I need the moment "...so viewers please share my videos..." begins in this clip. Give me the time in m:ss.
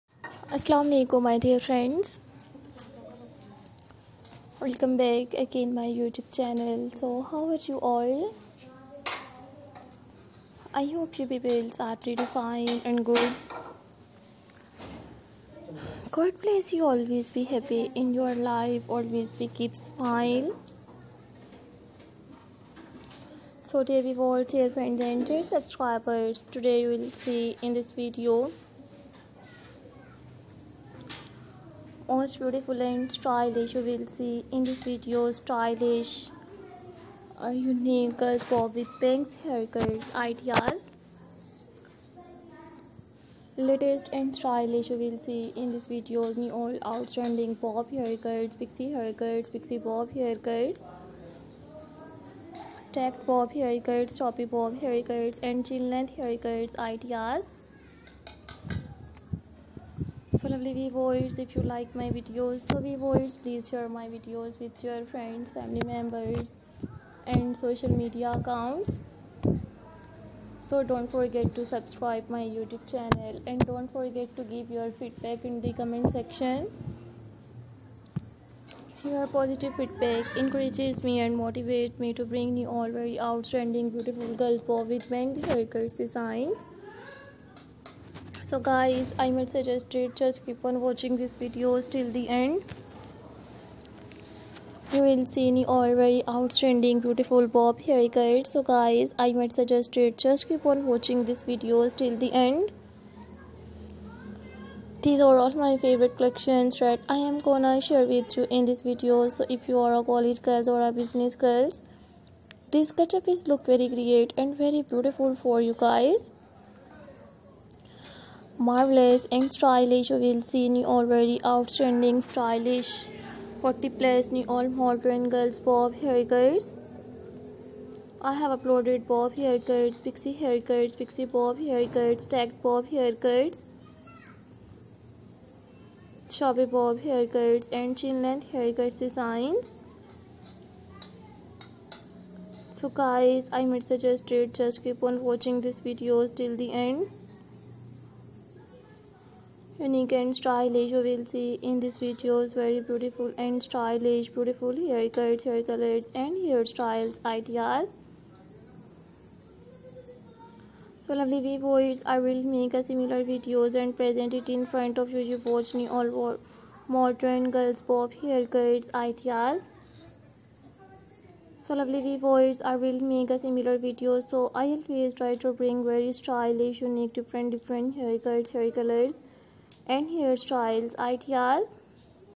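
1:02.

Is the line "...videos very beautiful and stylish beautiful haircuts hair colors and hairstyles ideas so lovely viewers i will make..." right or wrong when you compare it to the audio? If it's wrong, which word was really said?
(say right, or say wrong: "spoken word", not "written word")
right.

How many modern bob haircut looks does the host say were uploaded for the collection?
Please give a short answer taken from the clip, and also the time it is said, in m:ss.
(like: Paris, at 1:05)
40 plus, at 2:03.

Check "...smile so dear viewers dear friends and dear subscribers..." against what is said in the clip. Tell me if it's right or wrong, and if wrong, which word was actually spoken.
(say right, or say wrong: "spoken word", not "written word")
right.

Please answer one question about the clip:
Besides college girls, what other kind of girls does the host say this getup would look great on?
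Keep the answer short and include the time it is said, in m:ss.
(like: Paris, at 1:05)
business girls, at 1:51.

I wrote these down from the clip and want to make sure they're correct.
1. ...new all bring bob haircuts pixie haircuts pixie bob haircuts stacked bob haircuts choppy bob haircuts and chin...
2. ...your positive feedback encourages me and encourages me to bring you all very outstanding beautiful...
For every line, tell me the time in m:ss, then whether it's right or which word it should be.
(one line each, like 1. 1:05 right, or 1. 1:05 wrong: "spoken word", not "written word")
1. 0:46 wrong: "outstanding", not "bring"
2. 1:19 wrong: "motivates", not "encourages".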